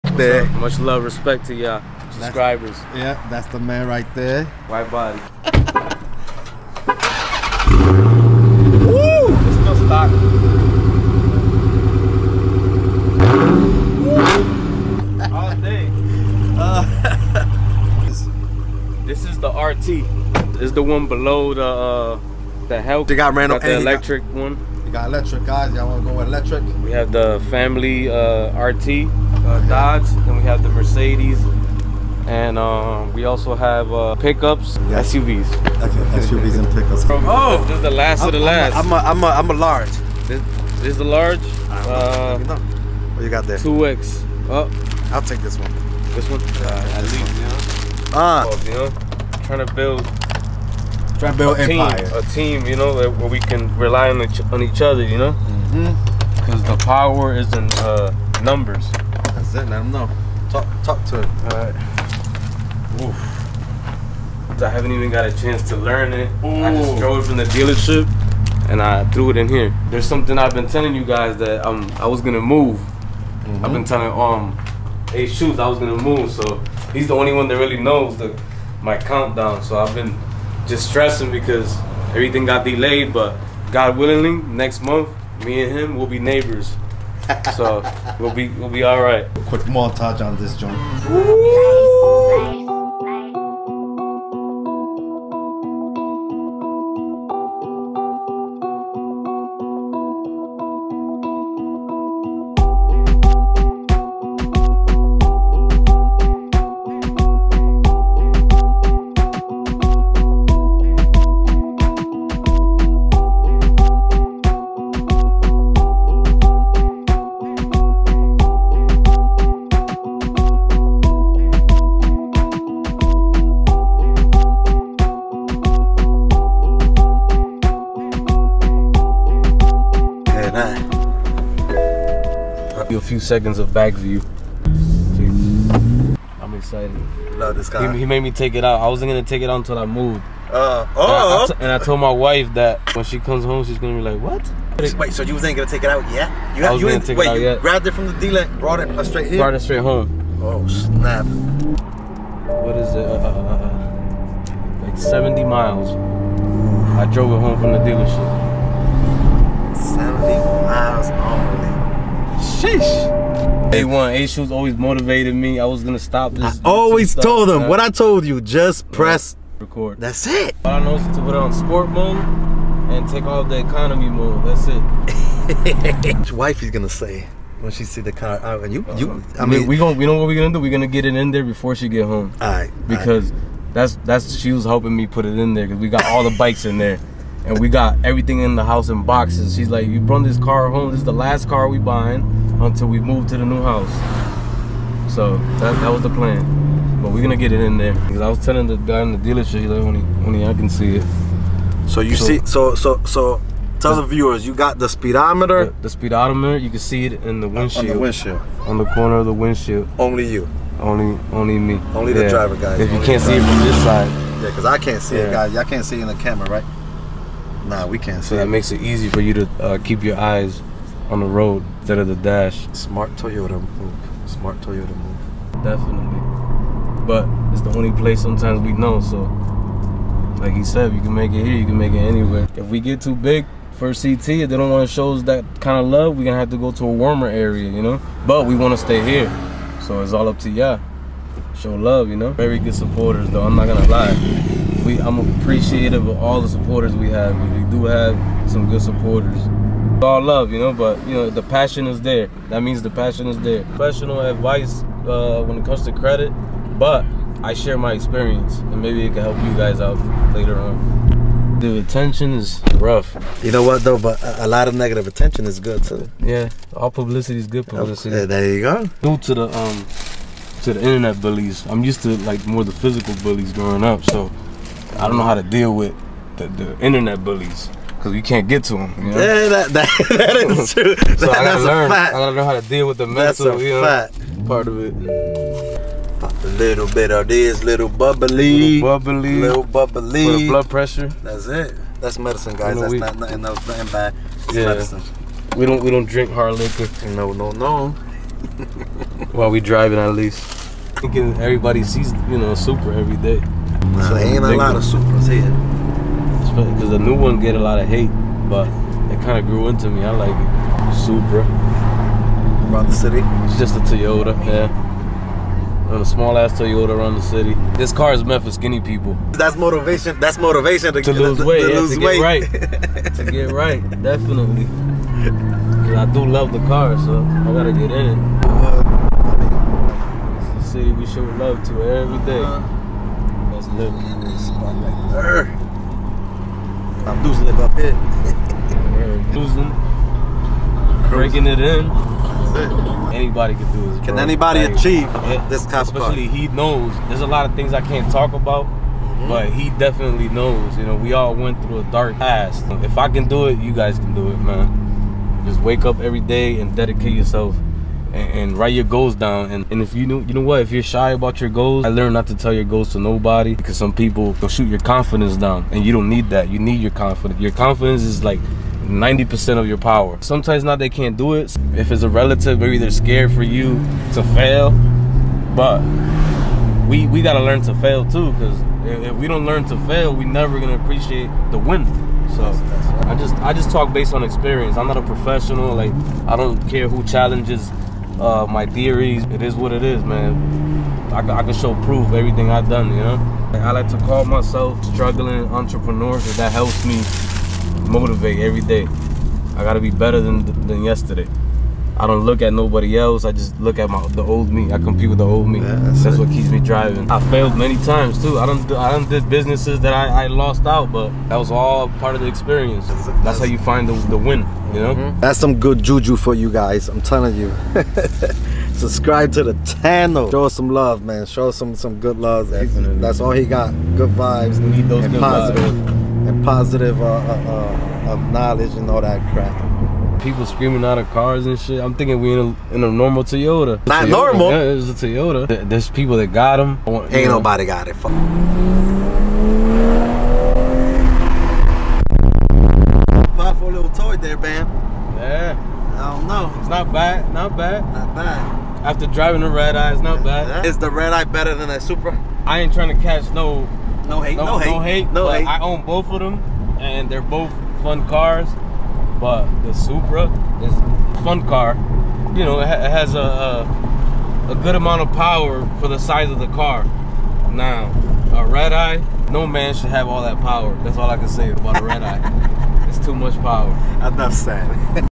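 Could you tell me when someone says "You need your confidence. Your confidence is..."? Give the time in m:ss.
6:06.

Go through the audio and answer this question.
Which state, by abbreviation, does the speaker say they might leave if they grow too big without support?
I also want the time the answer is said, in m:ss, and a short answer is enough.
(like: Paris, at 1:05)
CT, at 3:53.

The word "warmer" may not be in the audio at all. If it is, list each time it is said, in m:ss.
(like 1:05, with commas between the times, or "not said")
3:56.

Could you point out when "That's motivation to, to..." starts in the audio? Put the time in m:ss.
5:20.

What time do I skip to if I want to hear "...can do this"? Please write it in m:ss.
5:43.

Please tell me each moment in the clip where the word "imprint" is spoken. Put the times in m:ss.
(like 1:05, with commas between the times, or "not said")
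not said.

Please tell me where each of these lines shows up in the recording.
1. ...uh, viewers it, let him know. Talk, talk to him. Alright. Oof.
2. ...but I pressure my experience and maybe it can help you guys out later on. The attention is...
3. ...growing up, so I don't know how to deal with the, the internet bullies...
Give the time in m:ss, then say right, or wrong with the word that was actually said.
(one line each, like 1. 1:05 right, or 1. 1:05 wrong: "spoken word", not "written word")
1. 0:57 wrong: "numbers", not "viewers"
2. 4:16 wrong: "share", not "pressure"
3. 4:33 right.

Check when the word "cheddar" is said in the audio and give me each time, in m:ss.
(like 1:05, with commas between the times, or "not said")
not said.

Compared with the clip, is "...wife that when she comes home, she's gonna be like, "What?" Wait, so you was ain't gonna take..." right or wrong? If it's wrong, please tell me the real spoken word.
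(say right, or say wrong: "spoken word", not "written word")
right.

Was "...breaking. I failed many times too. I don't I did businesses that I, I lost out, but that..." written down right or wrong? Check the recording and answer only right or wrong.
wrong.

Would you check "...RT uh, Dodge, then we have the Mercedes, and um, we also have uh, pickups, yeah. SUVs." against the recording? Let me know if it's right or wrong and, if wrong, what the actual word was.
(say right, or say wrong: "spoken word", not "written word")
right.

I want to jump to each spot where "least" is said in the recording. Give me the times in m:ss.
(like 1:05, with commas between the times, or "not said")
0:47, 5:00.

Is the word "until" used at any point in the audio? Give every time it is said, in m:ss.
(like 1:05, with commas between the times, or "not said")
2:19, 3:12.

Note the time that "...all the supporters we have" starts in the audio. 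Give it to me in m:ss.
4:06.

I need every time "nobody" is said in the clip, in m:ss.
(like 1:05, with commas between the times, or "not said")
6:02, 6:42, 7:17.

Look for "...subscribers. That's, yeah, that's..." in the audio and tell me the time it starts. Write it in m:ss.
0:02.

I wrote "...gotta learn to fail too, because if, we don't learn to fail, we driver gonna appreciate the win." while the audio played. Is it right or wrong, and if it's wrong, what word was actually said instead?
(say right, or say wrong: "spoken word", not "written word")
wrong: "never", not "driver".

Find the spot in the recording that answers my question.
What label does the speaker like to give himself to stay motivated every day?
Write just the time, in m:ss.
6:34.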